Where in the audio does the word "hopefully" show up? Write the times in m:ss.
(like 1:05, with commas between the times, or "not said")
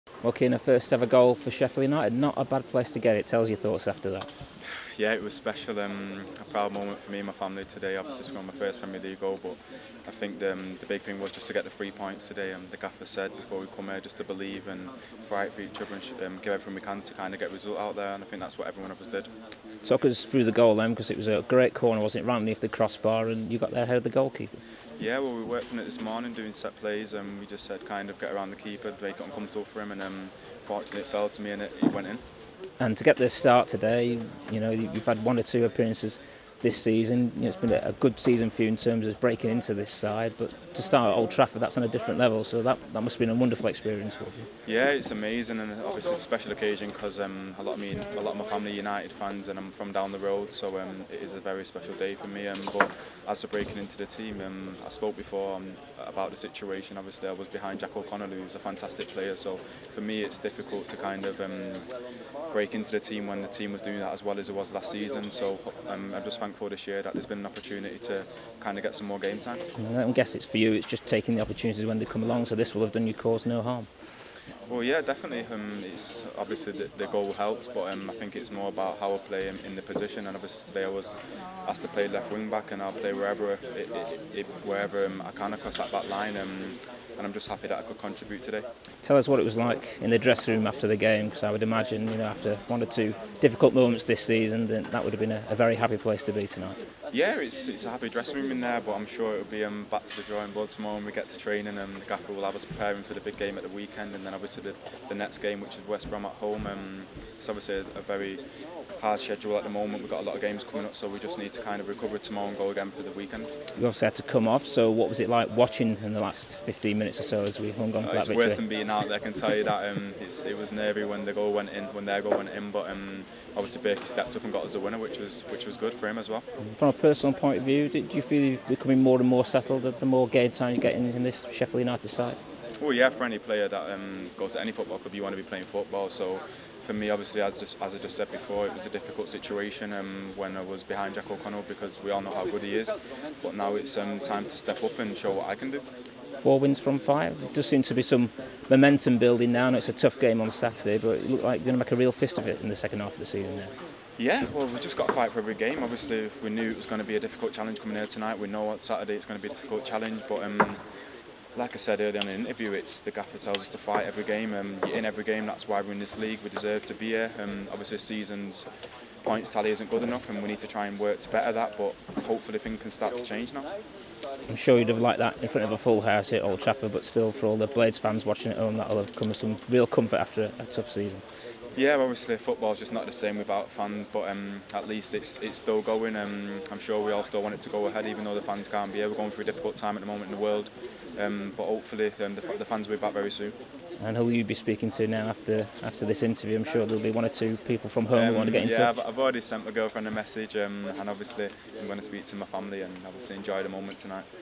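2:52, 3:11.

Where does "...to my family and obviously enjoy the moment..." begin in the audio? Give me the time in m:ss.
3:22.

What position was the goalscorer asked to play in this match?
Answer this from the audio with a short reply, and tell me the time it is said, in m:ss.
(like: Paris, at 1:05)
Left wing back, at 1:22.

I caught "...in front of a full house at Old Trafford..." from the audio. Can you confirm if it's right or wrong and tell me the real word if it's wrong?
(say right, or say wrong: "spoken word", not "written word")
right.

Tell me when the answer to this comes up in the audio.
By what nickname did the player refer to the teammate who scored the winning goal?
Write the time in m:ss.
2:03.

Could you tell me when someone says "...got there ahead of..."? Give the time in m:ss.
0:23.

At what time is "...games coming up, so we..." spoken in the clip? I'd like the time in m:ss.
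1:50.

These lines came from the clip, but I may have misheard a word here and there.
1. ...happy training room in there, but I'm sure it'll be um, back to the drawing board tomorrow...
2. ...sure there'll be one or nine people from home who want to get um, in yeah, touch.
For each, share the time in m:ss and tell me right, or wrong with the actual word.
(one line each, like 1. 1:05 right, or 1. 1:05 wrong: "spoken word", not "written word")
1. 1:37 wrong: "dressing", not "training"
2. 3:16 wrong: "two", not "nine".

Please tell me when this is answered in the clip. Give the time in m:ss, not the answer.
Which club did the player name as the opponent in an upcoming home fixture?
1:45.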